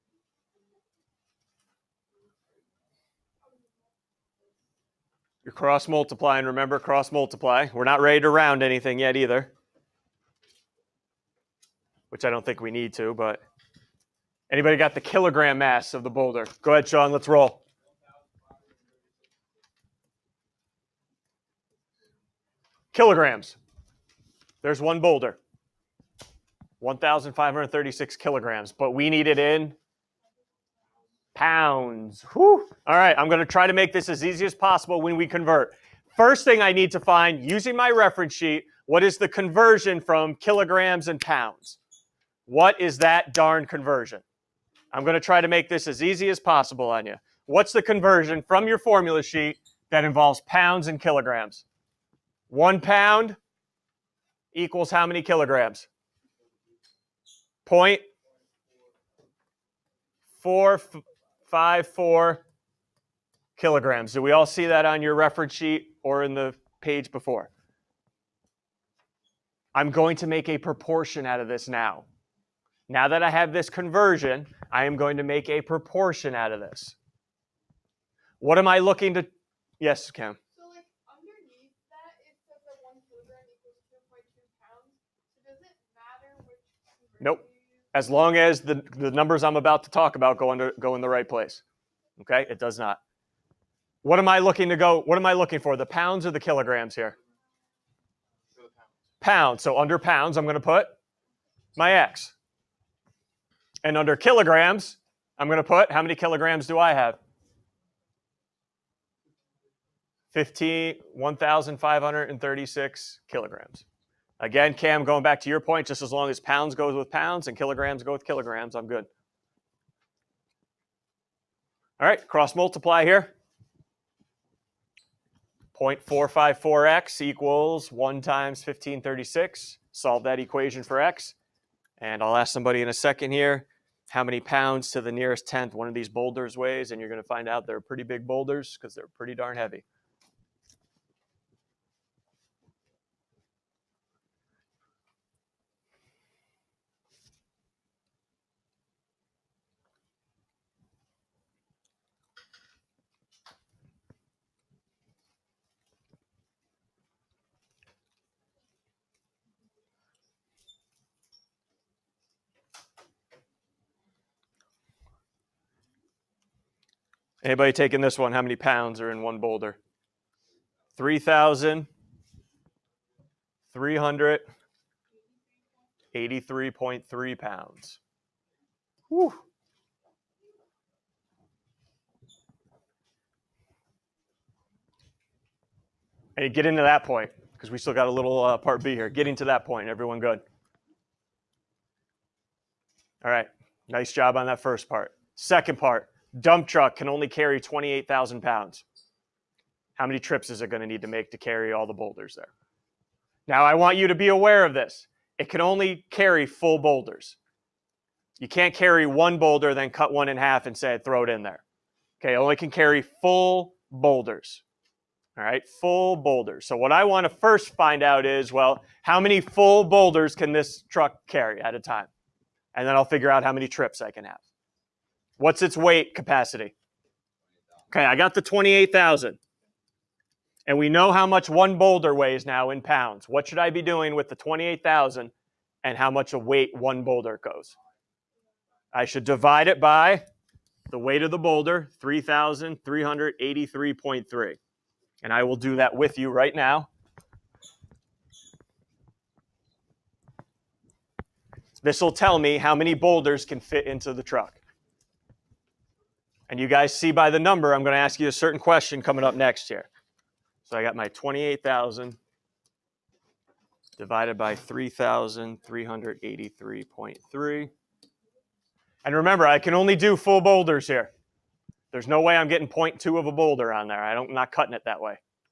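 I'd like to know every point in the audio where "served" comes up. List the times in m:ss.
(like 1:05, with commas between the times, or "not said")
not said.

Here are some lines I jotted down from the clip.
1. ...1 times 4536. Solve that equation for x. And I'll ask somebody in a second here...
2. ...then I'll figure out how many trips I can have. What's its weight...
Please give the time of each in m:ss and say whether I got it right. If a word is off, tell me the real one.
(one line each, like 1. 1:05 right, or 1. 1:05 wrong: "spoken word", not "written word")
1. 2:07 wrong: "1536", not "4536"
2. 3:42 right.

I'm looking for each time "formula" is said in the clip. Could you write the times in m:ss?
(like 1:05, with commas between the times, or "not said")
0:48.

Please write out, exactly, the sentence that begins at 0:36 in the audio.
First thing I need to find using my reference sheet, what is the conversion from kilograms and pounds?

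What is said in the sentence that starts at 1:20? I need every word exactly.
So like underneath that, it says that one kilogram equals 2.2 pounds.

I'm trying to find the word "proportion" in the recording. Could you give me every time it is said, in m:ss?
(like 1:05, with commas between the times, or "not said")
1:10, 1:15.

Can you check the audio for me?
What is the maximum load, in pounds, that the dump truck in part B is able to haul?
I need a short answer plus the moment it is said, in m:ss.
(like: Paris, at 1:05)
28,000 pounds, at 3:17.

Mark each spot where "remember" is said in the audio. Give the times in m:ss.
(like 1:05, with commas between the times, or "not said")
0:06, 4:29.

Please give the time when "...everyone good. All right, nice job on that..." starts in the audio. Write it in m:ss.
3:09.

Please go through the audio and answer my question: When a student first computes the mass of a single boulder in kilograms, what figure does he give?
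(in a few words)
1,536 kilograms.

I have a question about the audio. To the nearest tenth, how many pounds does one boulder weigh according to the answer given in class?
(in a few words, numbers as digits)
3,383.3 pounds.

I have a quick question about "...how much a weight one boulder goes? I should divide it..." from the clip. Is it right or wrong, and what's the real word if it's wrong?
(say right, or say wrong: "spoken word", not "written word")
right.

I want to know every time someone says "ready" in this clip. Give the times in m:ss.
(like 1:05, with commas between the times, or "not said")
0:07.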